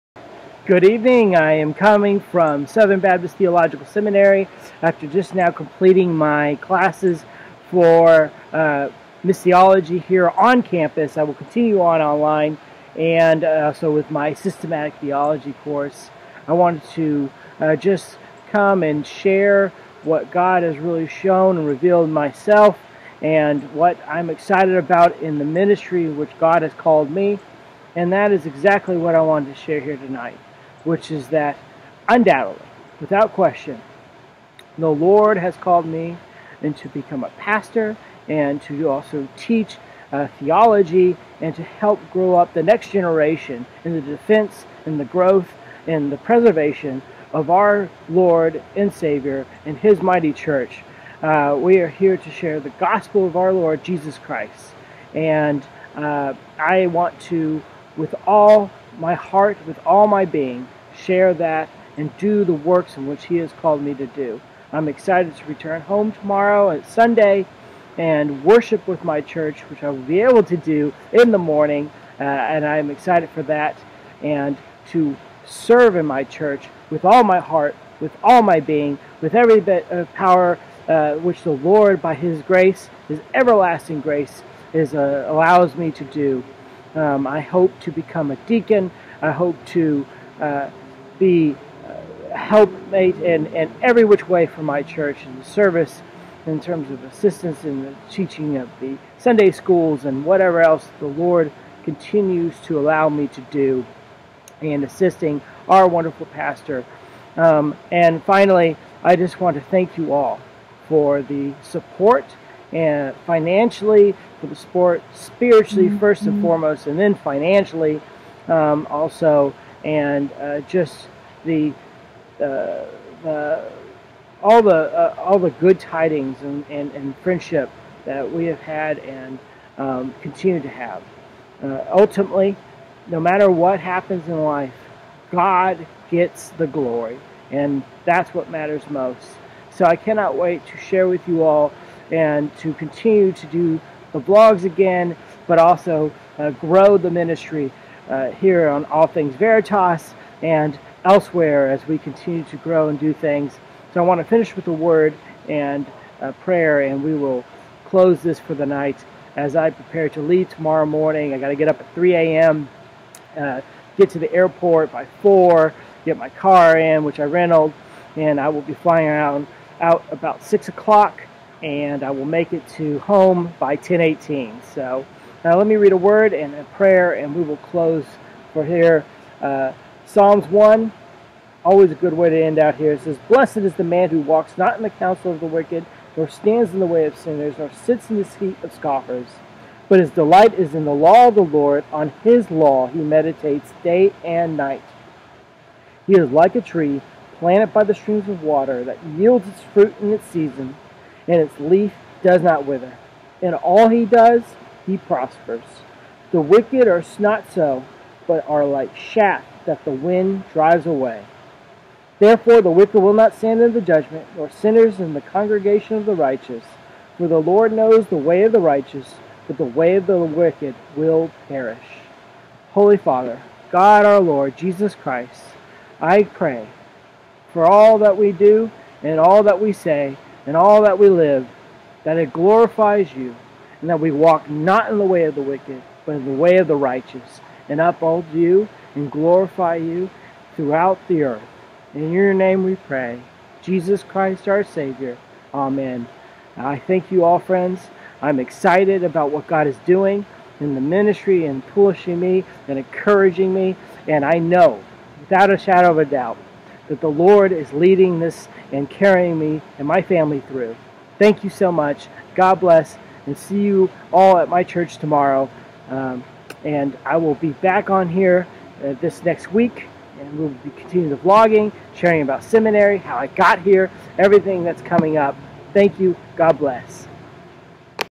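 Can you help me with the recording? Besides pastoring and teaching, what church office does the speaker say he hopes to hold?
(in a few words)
Deacon.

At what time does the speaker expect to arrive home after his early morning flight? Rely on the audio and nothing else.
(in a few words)
10:18.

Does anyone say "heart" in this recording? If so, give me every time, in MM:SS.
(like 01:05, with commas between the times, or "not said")
00:59, 01:17.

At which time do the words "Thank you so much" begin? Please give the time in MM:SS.
04:21.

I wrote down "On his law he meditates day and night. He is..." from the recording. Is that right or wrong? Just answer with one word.
right.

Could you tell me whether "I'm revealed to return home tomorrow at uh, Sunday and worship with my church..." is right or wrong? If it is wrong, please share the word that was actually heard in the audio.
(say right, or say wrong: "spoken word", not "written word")
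wrong: "excited", not "revealed".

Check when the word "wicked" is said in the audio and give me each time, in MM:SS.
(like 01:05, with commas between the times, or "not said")
03:05, 03:26, 03:32, 03:40, 03:55.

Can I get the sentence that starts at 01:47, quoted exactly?
Um, and finally, I just want to thank you all for the support and uh, financially, for the support spiritually, mm-hmm.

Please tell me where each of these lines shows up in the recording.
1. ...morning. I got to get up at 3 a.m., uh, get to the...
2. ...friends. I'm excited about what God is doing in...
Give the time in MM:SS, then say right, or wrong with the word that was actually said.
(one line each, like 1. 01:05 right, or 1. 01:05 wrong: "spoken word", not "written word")
1. 02:40 right
2. 04:07 right.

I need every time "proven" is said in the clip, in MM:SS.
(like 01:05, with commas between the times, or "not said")
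not said.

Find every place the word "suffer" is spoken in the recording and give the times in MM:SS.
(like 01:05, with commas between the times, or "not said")
not said.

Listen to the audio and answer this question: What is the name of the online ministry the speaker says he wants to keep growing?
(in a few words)
All Things Veritas.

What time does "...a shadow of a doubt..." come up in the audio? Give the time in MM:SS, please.
04:15.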